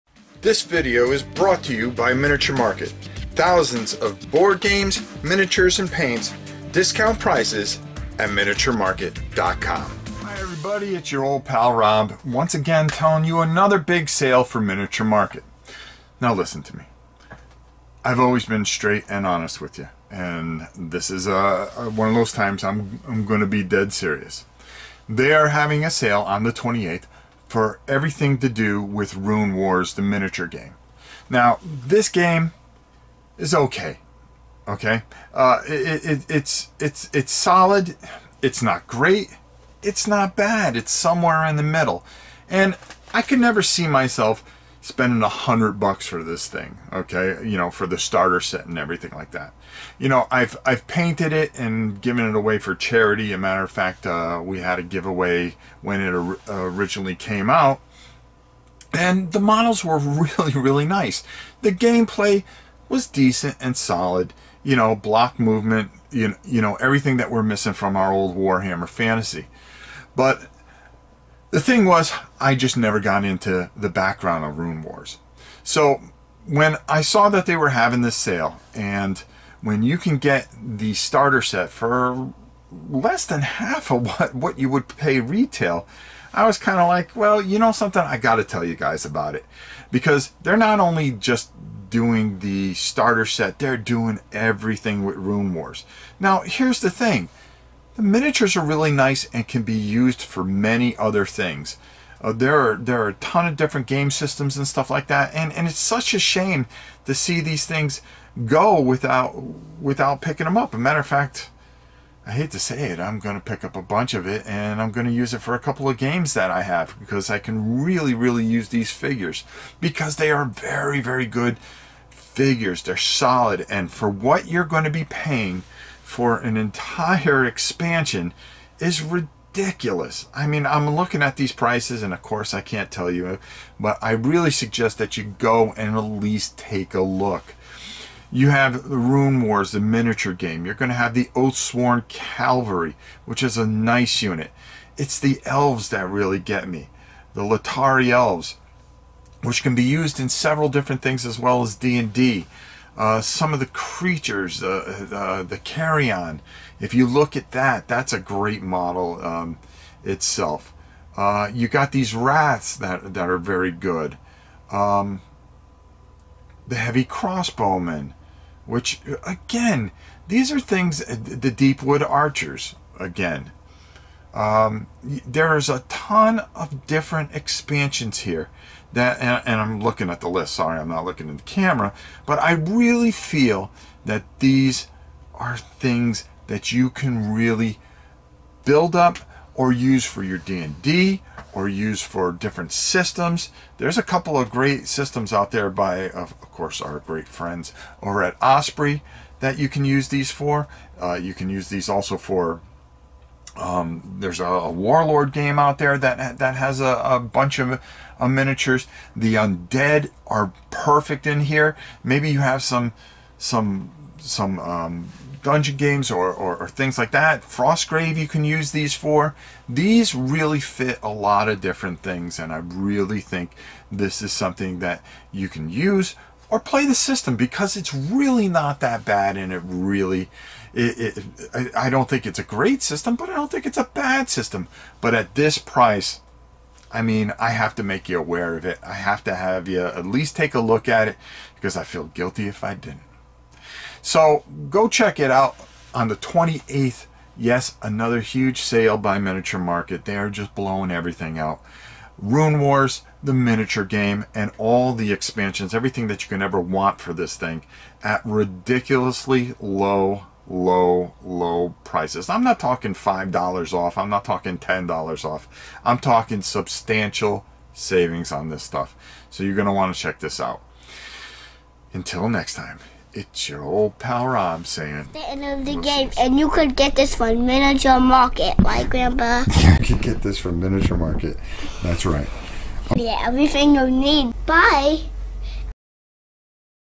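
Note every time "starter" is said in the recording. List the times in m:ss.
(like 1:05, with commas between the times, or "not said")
0:47, 1:20, 1:32.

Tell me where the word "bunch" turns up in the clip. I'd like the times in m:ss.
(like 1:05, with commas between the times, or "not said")
1:53, 3:27.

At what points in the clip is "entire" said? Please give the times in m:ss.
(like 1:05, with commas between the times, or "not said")
2:06.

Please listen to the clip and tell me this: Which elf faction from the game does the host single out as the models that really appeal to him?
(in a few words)
Latari elves.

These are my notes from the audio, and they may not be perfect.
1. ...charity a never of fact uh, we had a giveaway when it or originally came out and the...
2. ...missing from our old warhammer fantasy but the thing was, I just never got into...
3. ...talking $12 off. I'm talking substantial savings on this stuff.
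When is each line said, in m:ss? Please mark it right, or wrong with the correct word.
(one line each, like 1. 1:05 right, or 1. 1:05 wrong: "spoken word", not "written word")
1. 0:52 wrong: "matter", not "never"
2. 1:07 right
3. 4:24 wrong: "10", not "12".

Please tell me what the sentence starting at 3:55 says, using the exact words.
But at this price, I mean, I have to make you aware of it.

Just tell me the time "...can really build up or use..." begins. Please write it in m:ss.
3:06.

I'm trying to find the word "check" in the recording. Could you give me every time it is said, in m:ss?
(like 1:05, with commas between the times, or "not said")
4:04, 4:29.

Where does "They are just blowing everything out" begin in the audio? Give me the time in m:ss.
4:10.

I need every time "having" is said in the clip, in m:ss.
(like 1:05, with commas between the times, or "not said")
0:25, 1:17.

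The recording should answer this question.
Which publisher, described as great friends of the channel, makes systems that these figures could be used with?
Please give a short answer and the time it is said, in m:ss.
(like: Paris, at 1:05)
Osprey, at 3:18.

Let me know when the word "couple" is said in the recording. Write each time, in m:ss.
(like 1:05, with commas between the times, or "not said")
1:55, 3:14.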